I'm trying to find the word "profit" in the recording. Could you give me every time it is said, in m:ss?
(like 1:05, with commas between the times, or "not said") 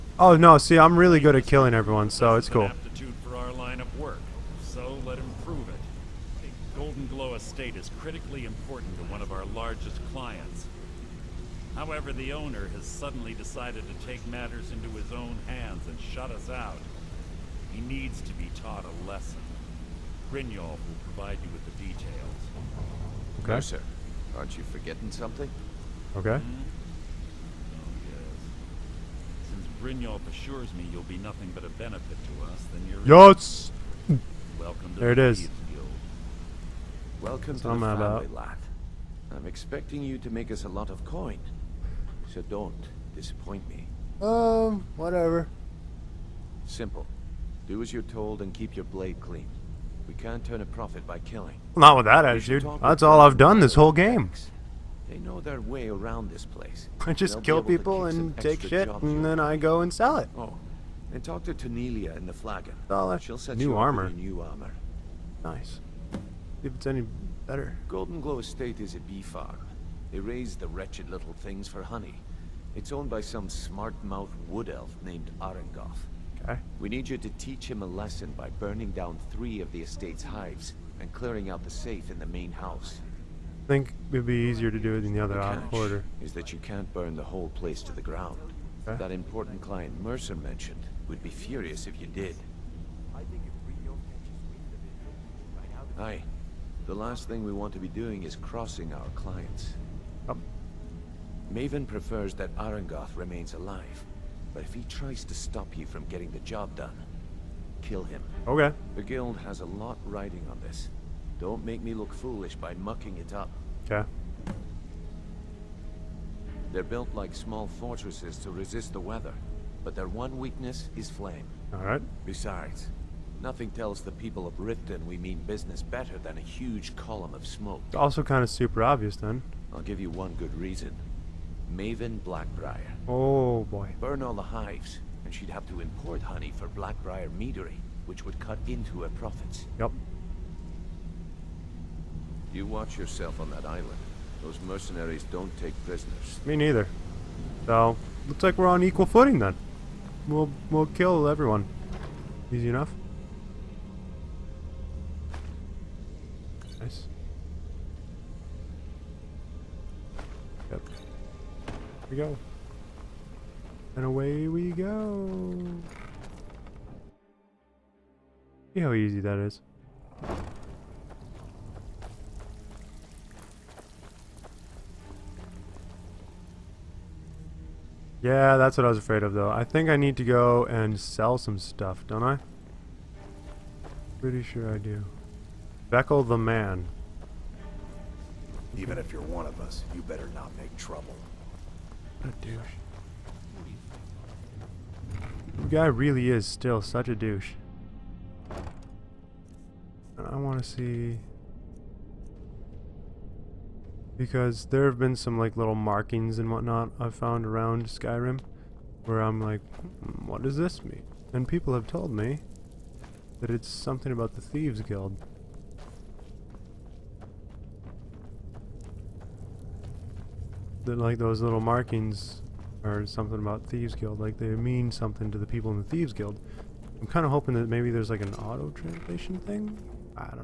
0:50, 2:19.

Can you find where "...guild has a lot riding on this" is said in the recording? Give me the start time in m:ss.
1:49.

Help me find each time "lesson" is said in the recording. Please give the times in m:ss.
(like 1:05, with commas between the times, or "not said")
0:19, 1:17.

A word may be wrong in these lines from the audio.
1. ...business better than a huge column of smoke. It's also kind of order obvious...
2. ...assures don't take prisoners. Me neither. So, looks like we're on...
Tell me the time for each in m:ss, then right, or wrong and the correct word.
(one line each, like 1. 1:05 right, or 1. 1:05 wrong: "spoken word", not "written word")
1. 2:05 wrong: "super", not "order"
2. 2:24 wrong: "mercenaries", not "assures".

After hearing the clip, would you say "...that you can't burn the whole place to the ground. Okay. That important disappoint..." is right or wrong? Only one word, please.
wrong.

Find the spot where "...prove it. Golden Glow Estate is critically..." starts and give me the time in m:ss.
0:05.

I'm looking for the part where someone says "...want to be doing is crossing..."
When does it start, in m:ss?
1:37.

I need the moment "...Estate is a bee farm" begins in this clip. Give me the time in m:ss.
1:08.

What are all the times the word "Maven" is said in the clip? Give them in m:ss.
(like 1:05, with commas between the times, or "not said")
1:41, 2:11.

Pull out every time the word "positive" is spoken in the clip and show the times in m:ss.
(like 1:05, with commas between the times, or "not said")
not said.